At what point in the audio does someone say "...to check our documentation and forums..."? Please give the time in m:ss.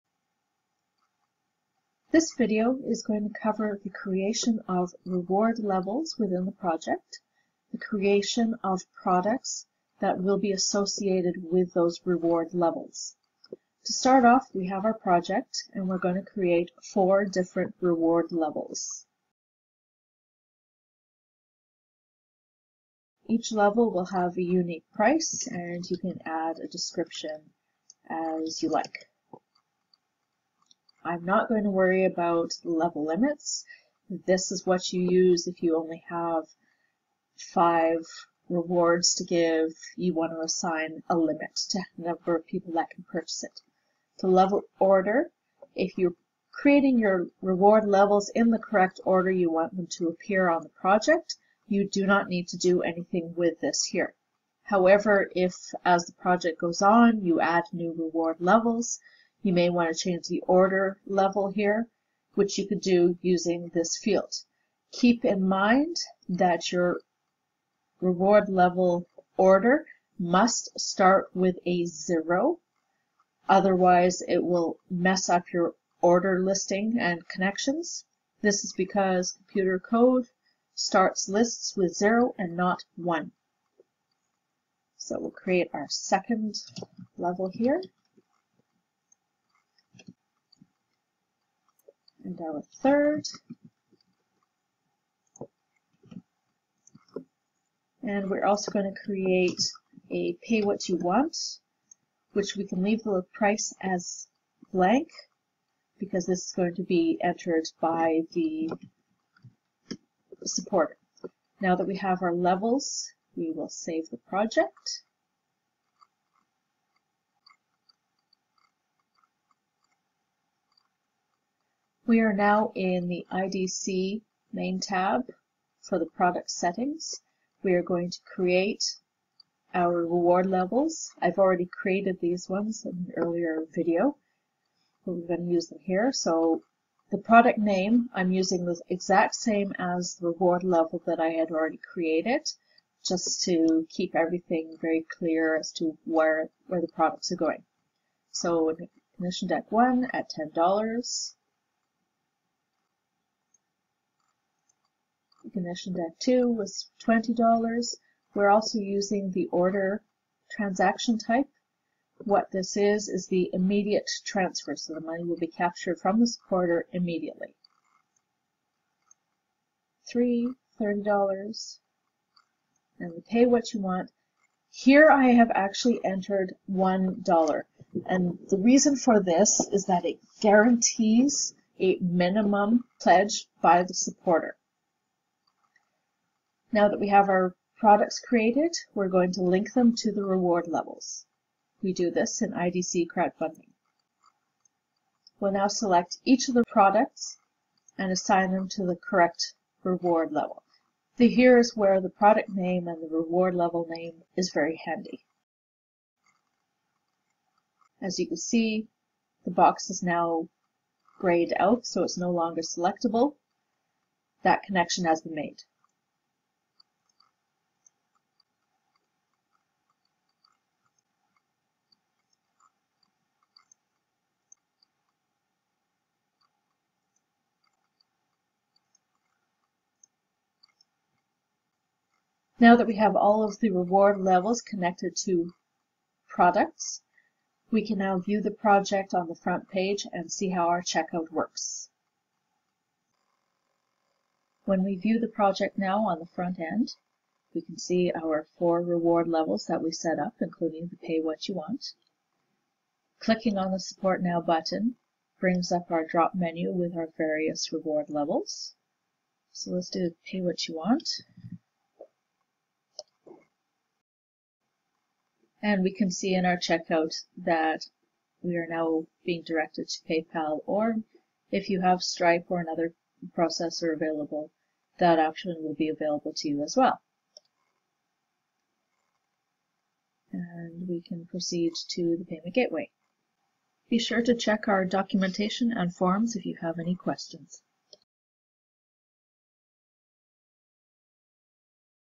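4:44.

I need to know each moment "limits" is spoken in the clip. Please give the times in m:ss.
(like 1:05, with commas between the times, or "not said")
0:33, 0:41.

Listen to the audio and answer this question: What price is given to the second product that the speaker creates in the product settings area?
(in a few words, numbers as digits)
$20.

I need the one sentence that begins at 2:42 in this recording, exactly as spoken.
What this is, is the immediate transfer, so the money will be captured from the supporter immediately.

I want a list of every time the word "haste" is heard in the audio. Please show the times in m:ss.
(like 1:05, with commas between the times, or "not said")
not said.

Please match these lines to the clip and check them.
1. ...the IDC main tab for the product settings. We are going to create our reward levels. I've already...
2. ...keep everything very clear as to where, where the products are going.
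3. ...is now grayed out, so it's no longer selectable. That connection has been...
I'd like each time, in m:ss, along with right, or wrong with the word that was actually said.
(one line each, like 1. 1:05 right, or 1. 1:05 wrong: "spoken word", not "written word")
1. 2:03 right
2. 2:23 right
3. 3:29 right.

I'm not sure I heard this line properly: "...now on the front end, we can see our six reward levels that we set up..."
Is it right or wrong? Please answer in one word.
wrong.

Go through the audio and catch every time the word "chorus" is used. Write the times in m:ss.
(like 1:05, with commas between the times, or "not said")
not said.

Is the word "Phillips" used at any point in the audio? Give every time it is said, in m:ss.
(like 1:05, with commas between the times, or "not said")
not said.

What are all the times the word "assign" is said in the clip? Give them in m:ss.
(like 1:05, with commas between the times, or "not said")
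0:40, 3:18.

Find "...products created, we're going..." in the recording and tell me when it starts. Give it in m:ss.
3:07.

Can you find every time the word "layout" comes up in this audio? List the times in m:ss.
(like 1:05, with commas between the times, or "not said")
not said.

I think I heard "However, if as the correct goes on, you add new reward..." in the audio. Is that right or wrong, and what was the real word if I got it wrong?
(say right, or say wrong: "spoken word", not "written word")
wrong: "project", not "correct".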